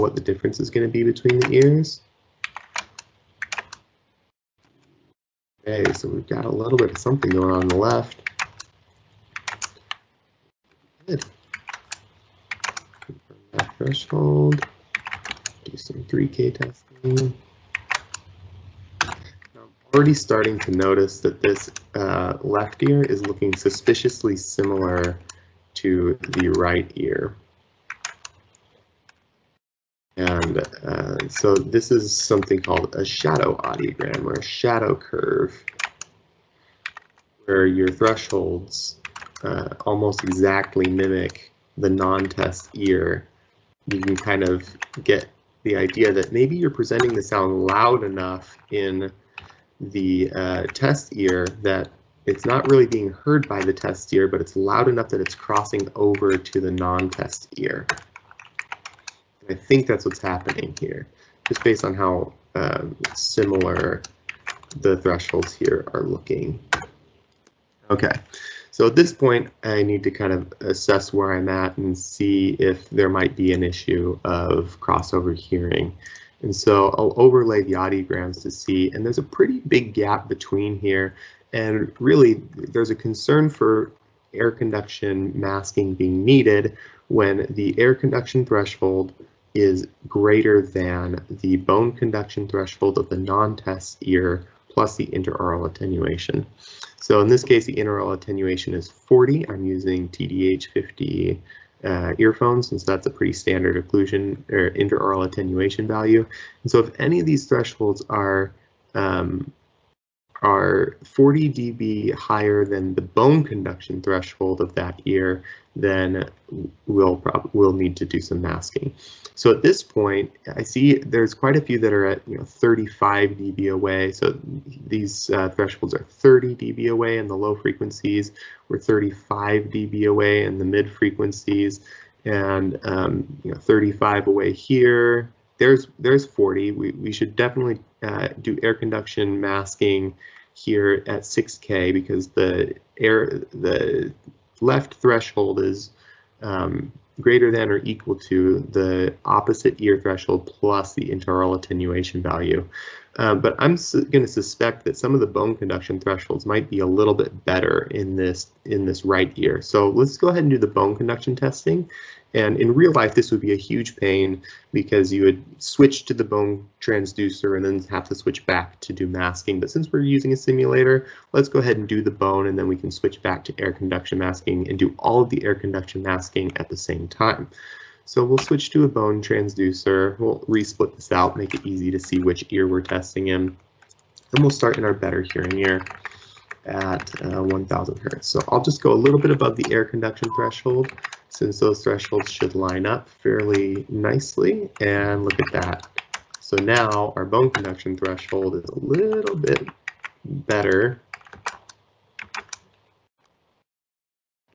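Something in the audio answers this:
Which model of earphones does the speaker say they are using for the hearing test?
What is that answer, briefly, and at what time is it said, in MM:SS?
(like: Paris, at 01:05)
TDH50, at 01:40.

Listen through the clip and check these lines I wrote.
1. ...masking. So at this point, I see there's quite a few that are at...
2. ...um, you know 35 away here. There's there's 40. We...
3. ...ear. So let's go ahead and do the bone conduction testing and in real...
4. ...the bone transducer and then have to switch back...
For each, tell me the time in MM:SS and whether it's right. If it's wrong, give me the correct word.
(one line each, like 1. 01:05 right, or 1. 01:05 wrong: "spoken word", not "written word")
1. 01:58 right
2. 02:12 right
3. 02:39 right
4. 02:46 right.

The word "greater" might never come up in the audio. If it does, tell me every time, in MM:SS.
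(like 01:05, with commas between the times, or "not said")
01:30, 02:27.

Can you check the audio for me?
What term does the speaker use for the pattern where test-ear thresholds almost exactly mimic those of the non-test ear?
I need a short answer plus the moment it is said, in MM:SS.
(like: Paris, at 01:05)
shadow audiogram, at 00:33.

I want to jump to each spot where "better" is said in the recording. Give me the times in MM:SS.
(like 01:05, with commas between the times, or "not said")
02:37, 03:04, 03:20.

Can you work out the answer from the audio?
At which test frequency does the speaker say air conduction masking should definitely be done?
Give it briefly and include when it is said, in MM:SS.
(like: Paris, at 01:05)
6K, at 02:21.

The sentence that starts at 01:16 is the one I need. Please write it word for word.
And so I'll overlay the audiograms to see, and there's a pretty big gap between here.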